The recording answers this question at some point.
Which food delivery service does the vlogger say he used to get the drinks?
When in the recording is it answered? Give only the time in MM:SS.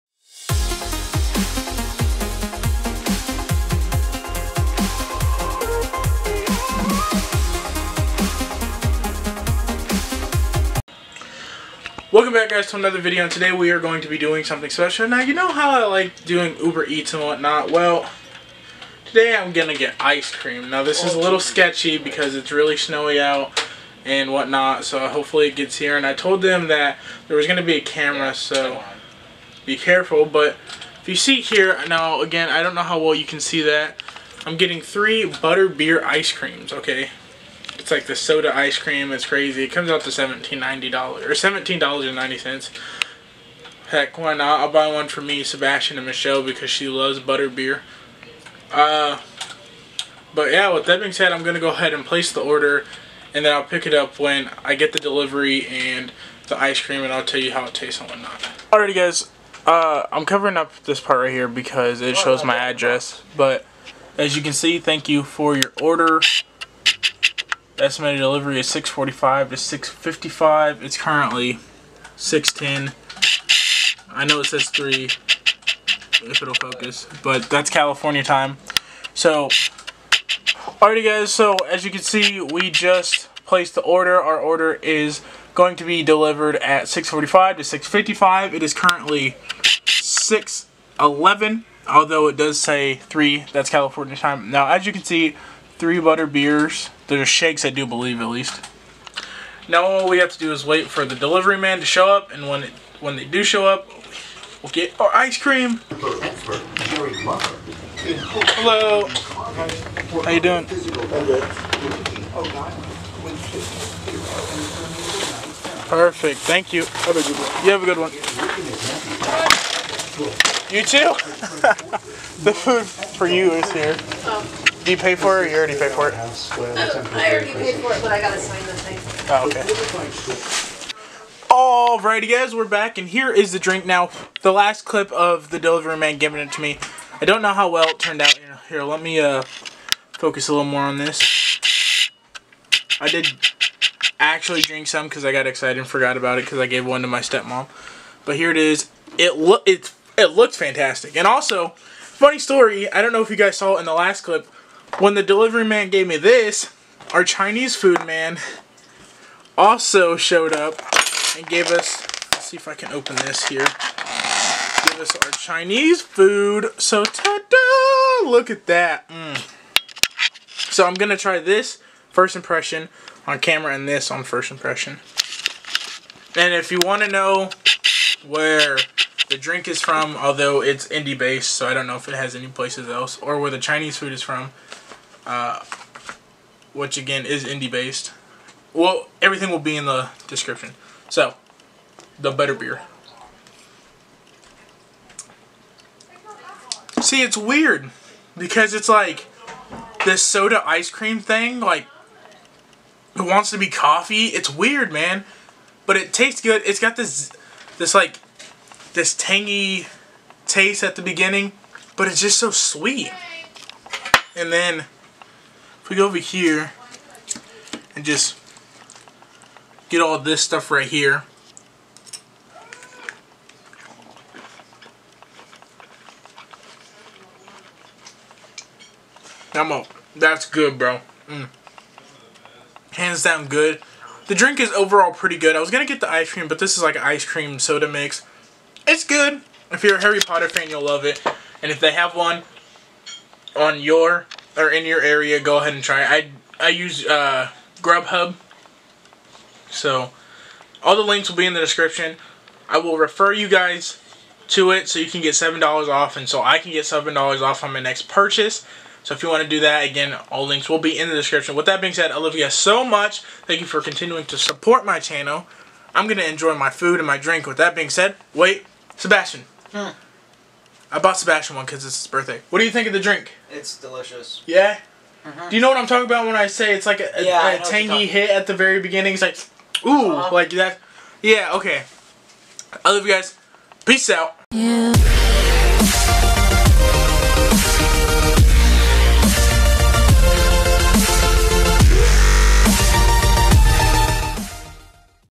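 04:07.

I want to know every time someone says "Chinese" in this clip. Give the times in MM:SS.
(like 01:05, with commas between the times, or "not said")
02:37, 02:45, 03:03.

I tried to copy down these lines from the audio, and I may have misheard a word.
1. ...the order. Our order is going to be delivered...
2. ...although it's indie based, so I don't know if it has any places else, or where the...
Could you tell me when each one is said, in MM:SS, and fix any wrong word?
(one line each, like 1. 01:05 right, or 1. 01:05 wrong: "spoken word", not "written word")
1. 01:23 right
2. 03:00 right.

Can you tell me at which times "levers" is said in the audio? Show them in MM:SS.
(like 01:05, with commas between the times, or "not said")
not said.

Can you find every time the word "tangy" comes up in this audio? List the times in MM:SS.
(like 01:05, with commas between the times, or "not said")
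03:29, 04:37.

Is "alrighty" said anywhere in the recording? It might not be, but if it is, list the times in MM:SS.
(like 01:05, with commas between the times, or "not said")
00:58, 01:20, 02:12.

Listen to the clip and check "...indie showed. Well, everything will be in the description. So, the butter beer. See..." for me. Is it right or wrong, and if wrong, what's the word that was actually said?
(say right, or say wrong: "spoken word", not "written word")
wrong: "based", not "showed".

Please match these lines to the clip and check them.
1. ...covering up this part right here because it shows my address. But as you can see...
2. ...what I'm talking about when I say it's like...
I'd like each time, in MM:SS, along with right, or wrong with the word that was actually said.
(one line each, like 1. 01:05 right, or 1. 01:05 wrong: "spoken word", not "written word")
1. 01:00 right
2. 04:35 right.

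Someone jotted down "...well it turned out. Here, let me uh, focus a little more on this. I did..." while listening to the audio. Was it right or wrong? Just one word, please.
right.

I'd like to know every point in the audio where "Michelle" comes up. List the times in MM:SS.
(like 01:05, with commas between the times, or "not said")
00:46.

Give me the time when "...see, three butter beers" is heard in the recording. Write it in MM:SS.
01:35.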